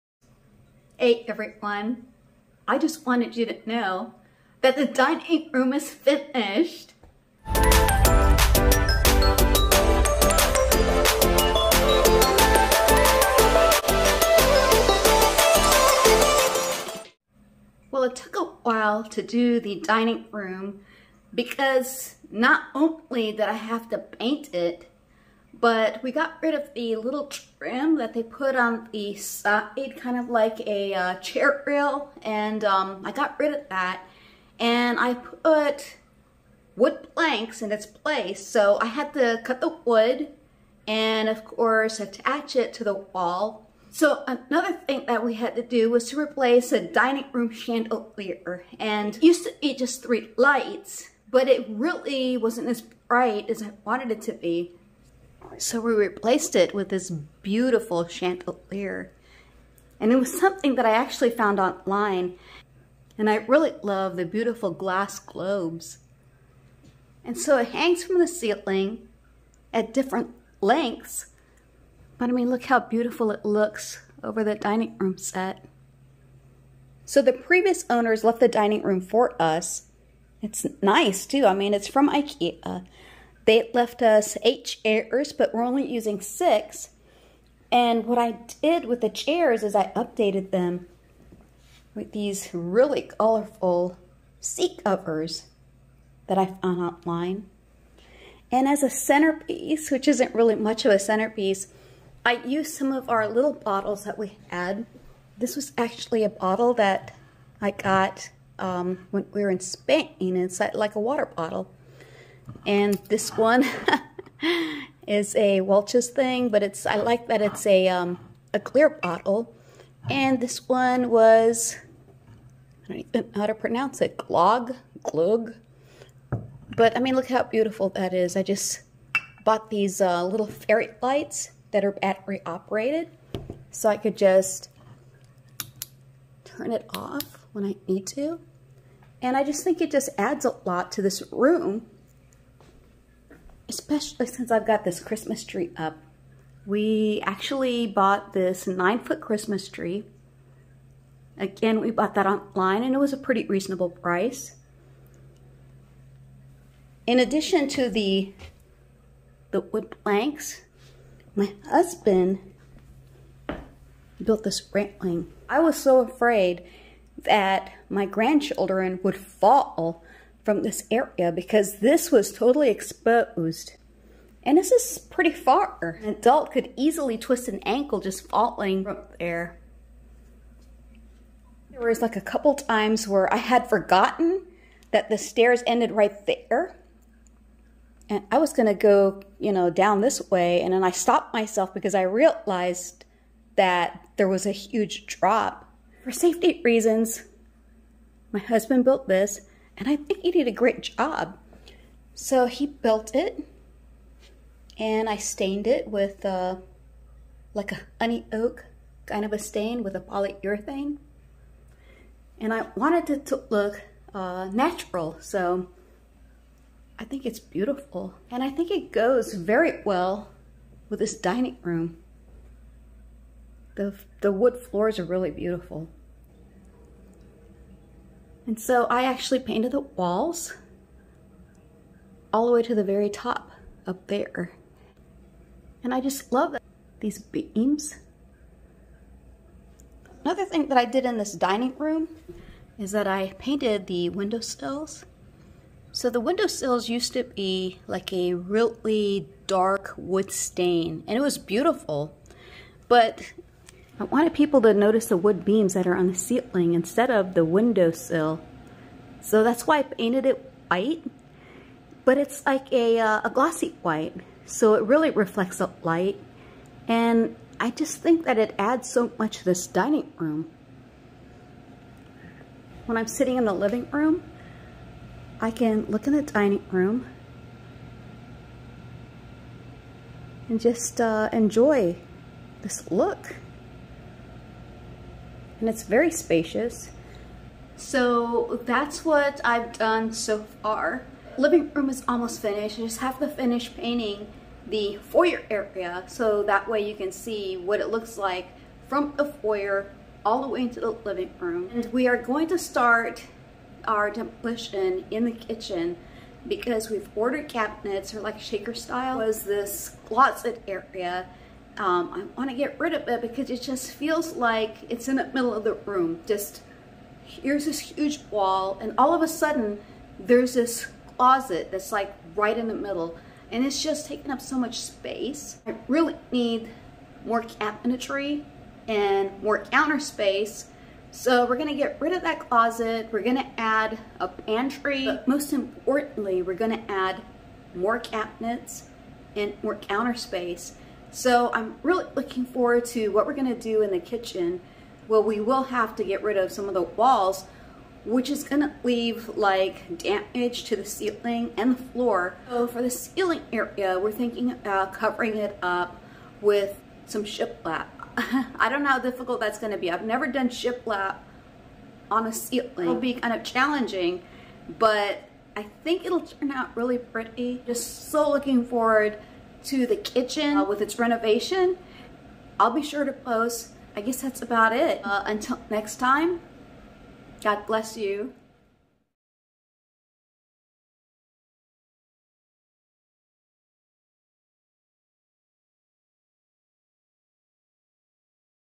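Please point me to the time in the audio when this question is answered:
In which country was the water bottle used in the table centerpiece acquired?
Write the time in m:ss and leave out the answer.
1:49.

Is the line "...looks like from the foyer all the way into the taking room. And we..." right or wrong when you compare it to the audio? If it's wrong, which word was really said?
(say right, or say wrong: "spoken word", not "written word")
wrong: "living", not "taking".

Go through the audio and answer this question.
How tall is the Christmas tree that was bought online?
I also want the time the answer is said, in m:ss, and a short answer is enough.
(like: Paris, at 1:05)
9 feet, at 2:28.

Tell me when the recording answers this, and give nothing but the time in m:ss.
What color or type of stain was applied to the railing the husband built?
3:27.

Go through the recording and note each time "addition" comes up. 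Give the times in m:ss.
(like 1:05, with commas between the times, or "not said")
2:37.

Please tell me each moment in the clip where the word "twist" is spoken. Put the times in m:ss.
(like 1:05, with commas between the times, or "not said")
2:57.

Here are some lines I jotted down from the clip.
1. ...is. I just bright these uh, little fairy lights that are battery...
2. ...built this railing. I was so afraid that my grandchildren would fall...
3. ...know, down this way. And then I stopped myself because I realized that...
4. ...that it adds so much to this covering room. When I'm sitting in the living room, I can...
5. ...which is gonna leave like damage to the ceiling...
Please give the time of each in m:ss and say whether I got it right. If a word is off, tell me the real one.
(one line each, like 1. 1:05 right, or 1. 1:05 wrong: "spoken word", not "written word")
1. 2:08 wrong: "bought", not "bright"
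2. 2:44 right
3. 3:09 right
4. 4:28 wrong: "dining", not "covering"
5. 5:48 right.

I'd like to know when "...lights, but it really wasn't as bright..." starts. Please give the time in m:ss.
0:50.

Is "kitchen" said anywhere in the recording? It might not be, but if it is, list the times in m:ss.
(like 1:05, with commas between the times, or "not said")
5:05, 5:43, 6:09.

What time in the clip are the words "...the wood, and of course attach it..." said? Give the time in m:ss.
0:39.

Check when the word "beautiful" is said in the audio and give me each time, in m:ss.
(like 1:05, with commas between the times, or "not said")
0:57, 1:04, 1:12, 2:07, 3:37, 3:45, 4:11.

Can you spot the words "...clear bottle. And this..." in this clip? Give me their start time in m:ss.
1:58.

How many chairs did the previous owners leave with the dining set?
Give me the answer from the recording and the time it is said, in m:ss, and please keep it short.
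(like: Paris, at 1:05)
8, at 1:24.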